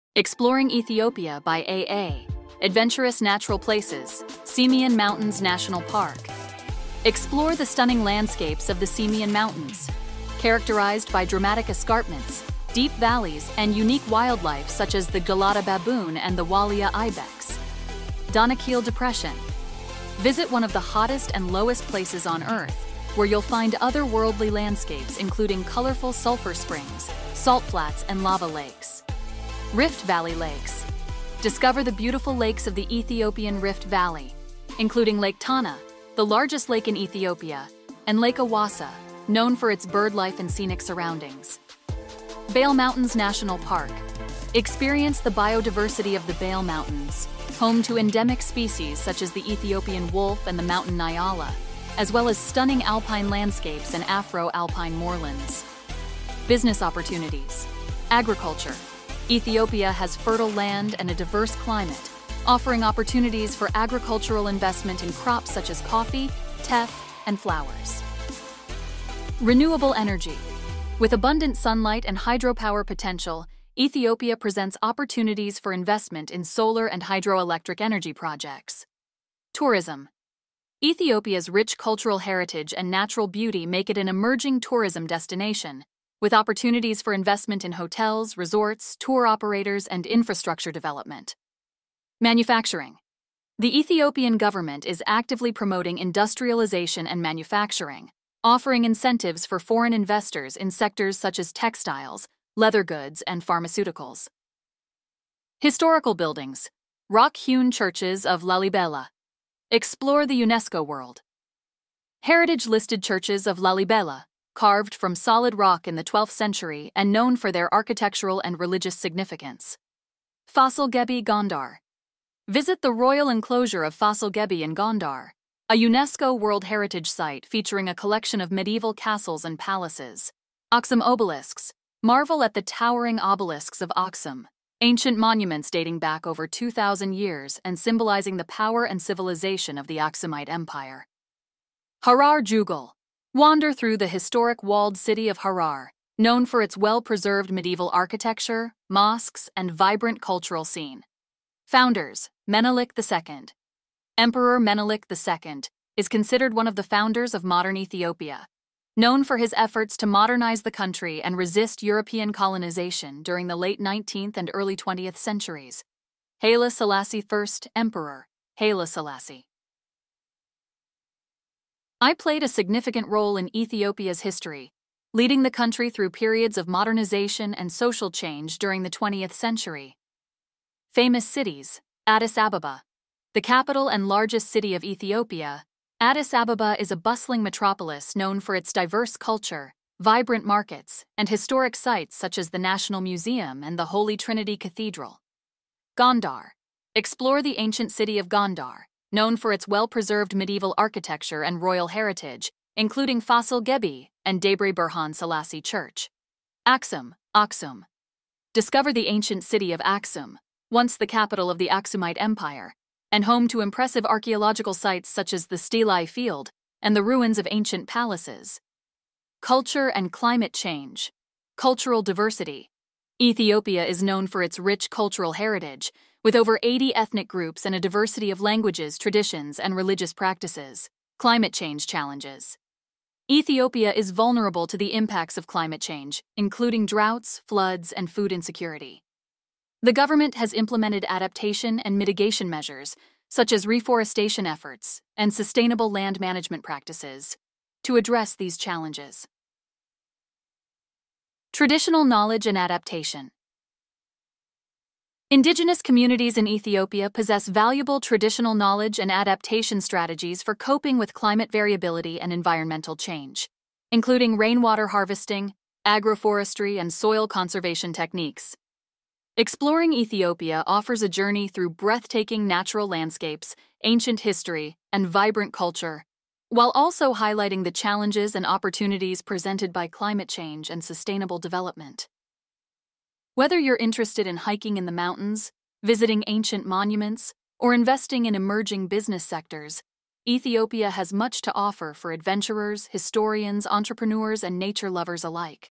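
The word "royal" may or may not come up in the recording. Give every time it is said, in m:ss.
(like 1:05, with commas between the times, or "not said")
2:02, 3:21.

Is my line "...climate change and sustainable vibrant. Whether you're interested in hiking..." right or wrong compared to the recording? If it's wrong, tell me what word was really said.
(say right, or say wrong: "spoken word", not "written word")
wrong: "development", not "vibrant".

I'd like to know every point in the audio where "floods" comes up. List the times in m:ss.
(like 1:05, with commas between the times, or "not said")
3:57.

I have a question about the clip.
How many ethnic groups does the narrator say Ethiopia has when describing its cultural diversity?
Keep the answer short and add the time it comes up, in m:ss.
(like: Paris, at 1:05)
over 80, at 3:46.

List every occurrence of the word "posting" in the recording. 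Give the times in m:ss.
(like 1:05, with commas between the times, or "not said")
not said.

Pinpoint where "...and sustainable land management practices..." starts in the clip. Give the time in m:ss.
4:05.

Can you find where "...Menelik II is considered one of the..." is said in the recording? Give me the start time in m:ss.
2:34.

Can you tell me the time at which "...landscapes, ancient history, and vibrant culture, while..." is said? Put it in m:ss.
4:32.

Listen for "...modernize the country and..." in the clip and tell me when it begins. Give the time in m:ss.
2:40.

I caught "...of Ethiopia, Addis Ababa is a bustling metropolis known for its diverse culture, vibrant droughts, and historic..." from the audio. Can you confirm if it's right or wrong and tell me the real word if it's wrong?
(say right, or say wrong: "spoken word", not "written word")
wrong: "markets", not "droughts".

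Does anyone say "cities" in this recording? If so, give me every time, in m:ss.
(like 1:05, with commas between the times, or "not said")
3:01.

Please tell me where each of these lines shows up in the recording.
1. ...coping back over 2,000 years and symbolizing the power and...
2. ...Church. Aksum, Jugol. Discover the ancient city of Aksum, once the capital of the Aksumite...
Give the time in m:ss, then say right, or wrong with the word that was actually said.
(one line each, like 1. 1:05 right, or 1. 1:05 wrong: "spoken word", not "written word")
1. 2:15 wrong: "dating", not "coping"
2. 3:25 wrong: "Aksum", not "Jugol".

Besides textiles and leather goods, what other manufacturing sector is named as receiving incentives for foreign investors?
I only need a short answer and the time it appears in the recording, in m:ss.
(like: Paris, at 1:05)
pharmaceuticals, at 1:43.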